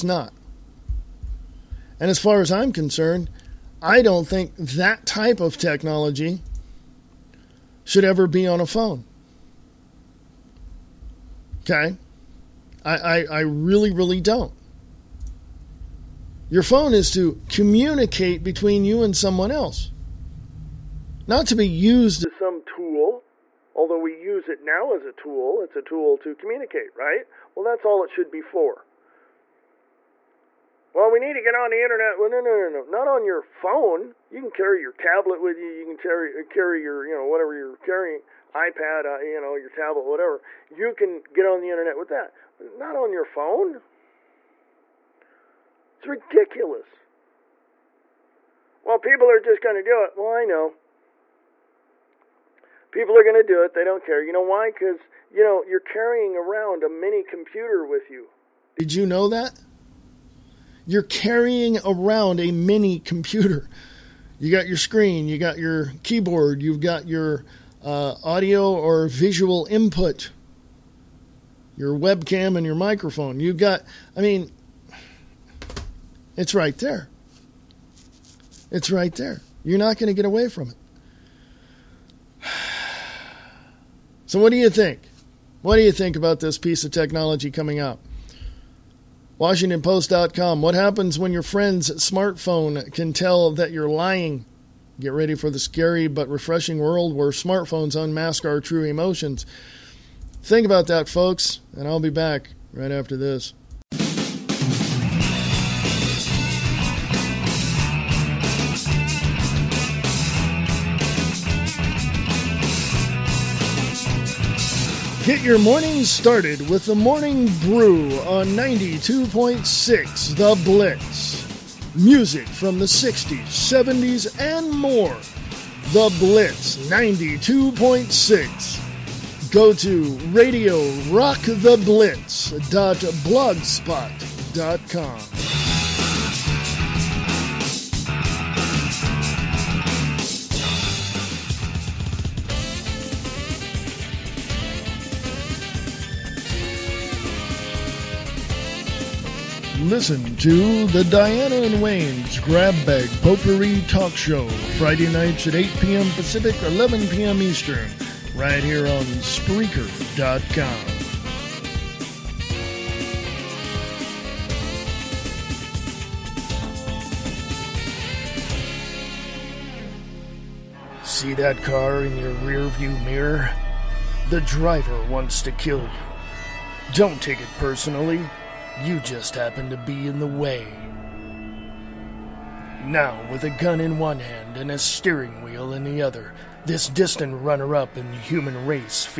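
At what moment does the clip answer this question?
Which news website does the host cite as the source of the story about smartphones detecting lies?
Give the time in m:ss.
1:29.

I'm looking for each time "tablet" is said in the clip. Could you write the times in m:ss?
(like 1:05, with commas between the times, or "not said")
0:34, 0:39.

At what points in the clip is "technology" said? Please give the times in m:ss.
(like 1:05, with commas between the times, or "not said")
0:05, 1:26.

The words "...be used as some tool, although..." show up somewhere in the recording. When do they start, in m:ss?
0:21.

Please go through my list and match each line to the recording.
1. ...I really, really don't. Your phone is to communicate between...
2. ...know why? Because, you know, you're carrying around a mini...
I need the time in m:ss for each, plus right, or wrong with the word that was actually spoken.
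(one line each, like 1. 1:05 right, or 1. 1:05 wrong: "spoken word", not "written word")
1. 0:13 right
2. 0:54 right.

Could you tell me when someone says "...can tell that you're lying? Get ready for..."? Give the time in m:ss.
1:32.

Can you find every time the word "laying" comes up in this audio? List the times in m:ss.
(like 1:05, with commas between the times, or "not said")
not said.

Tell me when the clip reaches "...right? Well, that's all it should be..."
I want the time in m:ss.
0:26.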